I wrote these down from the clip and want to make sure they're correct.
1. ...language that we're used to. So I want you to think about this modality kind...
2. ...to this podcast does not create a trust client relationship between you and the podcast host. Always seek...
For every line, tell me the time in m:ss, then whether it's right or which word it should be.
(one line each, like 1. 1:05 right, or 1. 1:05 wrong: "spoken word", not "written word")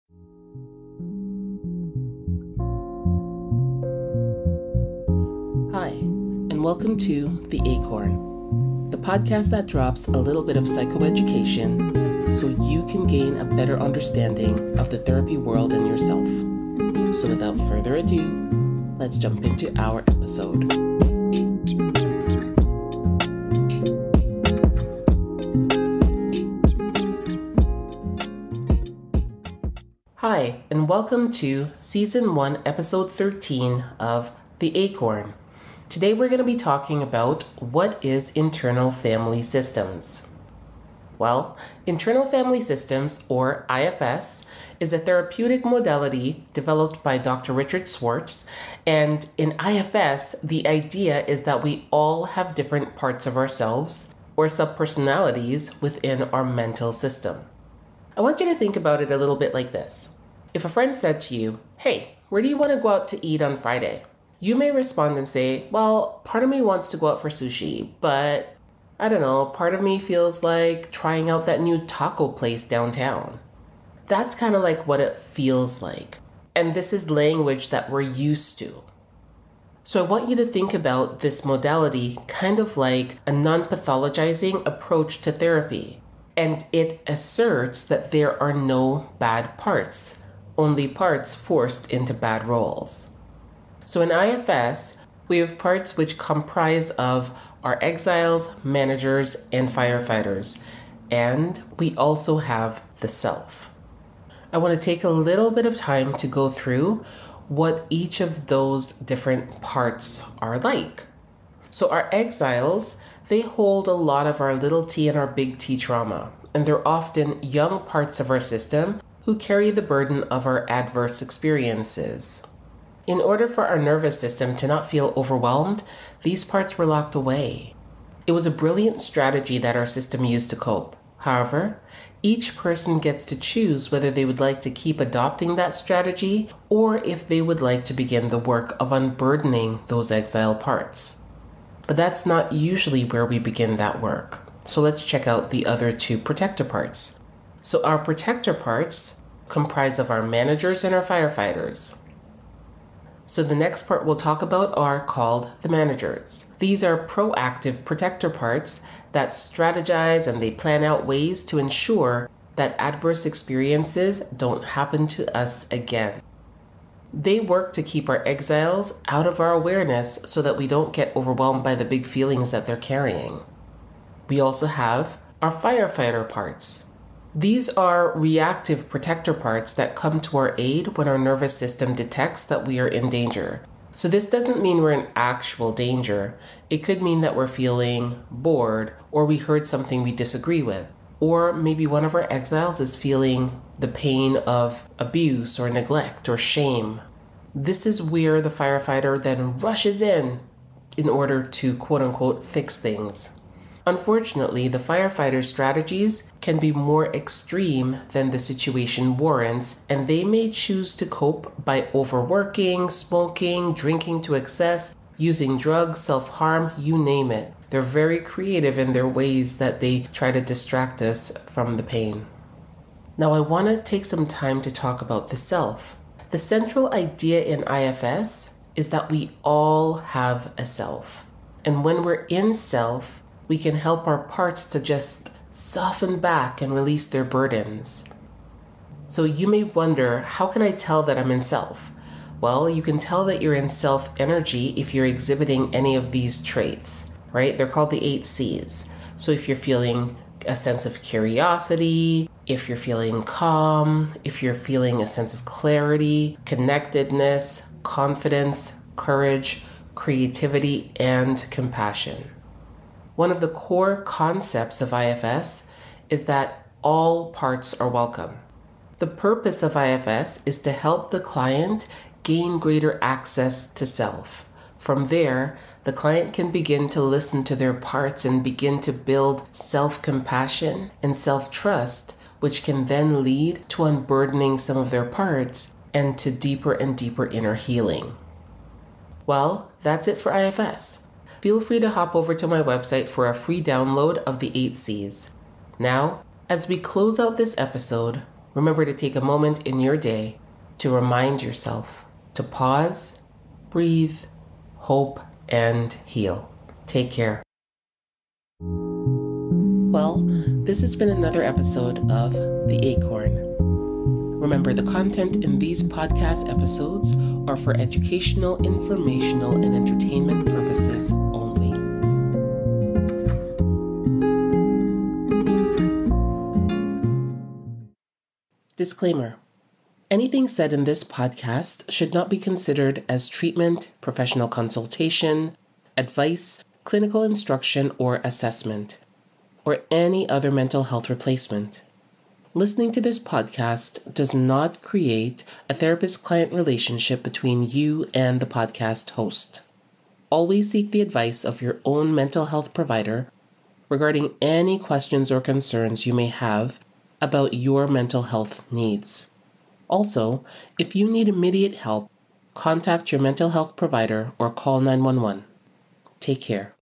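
1. 1:17 right
2. 5:42 wrong: "therapist", not "trust".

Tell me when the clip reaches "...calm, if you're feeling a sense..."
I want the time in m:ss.
4:13.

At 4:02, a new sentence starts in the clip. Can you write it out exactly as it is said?
Well, you can tell that you're in self energy if you're exhibiting any of these traits, right?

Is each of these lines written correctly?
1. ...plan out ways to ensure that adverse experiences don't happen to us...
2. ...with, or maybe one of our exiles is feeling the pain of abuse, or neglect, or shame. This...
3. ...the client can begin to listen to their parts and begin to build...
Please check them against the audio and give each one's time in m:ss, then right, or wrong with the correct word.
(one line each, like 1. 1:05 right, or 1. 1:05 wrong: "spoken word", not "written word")
1. 2:40 right
2. 3:10 right
3. 4:35 right.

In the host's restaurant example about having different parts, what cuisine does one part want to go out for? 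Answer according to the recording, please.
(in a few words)
Sushi.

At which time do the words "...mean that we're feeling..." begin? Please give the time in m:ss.
3:07.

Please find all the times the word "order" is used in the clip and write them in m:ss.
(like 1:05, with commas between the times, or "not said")
2:03, 3:21.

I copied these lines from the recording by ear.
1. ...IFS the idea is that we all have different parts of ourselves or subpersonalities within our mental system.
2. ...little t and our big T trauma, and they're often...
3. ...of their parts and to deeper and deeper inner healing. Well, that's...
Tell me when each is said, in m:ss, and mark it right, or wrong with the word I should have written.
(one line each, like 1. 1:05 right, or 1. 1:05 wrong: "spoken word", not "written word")
1. 0:49 right
2. 1:54 right
3. 4:44 right.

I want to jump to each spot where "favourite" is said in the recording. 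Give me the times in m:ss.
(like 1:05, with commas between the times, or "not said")
not said.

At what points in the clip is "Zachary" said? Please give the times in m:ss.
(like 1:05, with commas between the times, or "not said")
not said.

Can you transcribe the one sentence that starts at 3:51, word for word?
And when we're in self, we can help our parts to just soften back and release their burdens.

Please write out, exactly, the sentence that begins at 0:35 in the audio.
Today we're going to be talking about what is internal family systems.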